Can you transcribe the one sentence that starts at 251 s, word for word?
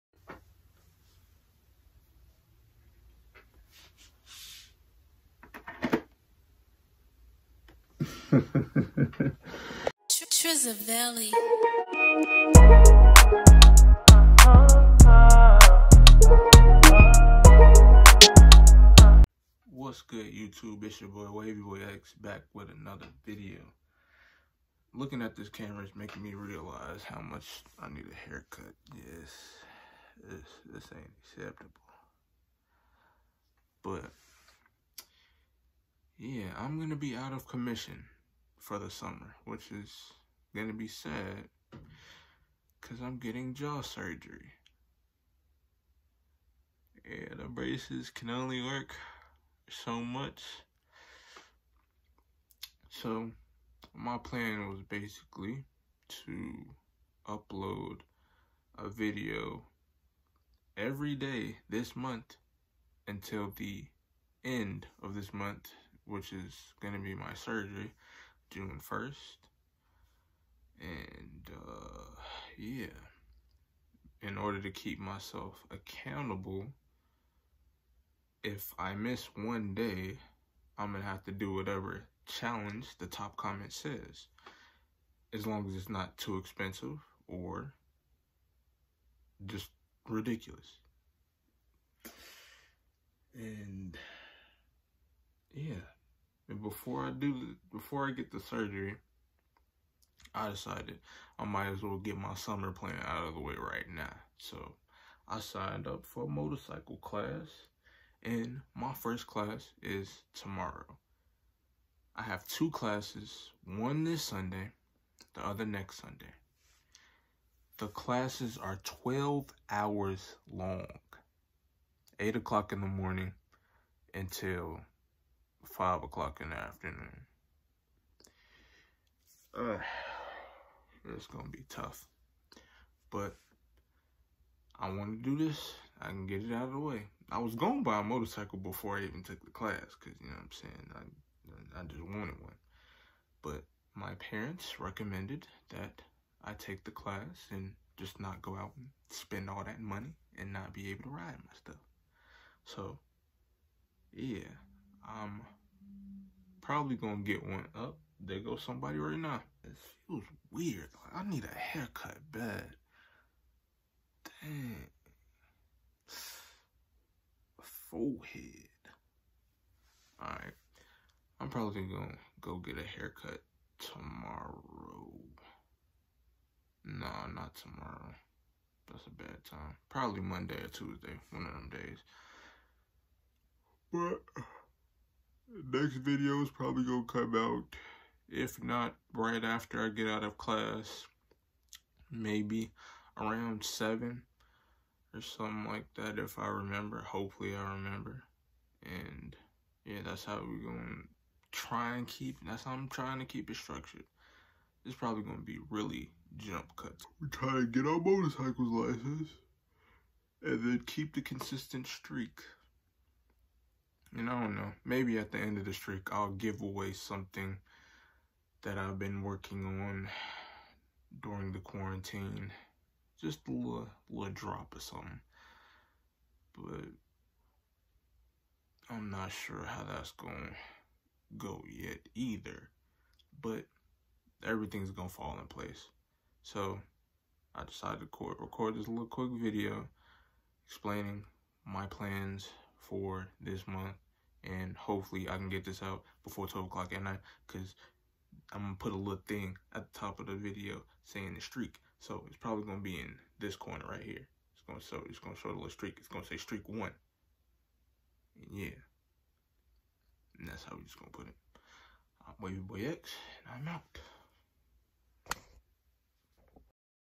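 So it's probably going to be in this corner right here.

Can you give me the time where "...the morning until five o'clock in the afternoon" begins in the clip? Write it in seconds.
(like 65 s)
122 s.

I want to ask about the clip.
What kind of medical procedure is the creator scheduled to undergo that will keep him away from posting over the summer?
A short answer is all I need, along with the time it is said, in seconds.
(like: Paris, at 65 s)
jaw surgery, at 43 s.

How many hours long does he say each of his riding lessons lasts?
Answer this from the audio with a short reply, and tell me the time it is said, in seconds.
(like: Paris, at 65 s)
12, at 118 s.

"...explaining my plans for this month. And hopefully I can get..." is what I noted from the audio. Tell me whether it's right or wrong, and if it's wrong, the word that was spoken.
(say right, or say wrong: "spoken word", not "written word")
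right.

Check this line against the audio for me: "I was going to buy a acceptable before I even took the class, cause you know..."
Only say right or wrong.
wrong.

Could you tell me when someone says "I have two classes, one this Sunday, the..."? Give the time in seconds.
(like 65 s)
112 s.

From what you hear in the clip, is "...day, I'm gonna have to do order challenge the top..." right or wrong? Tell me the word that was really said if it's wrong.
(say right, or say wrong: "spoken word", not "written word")
wrong: "whatever", not "order".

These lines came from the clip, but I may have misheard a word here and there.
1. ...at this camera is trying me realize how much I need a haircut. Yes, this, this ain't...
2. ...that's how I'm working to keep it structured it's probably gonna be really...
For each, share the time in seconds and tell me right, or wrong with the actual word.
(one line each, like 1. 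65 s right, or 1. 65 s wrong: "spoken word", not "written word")
1. 25 s wrong: "making", not "trying"
2. 202 s wrong: "trying", not "working".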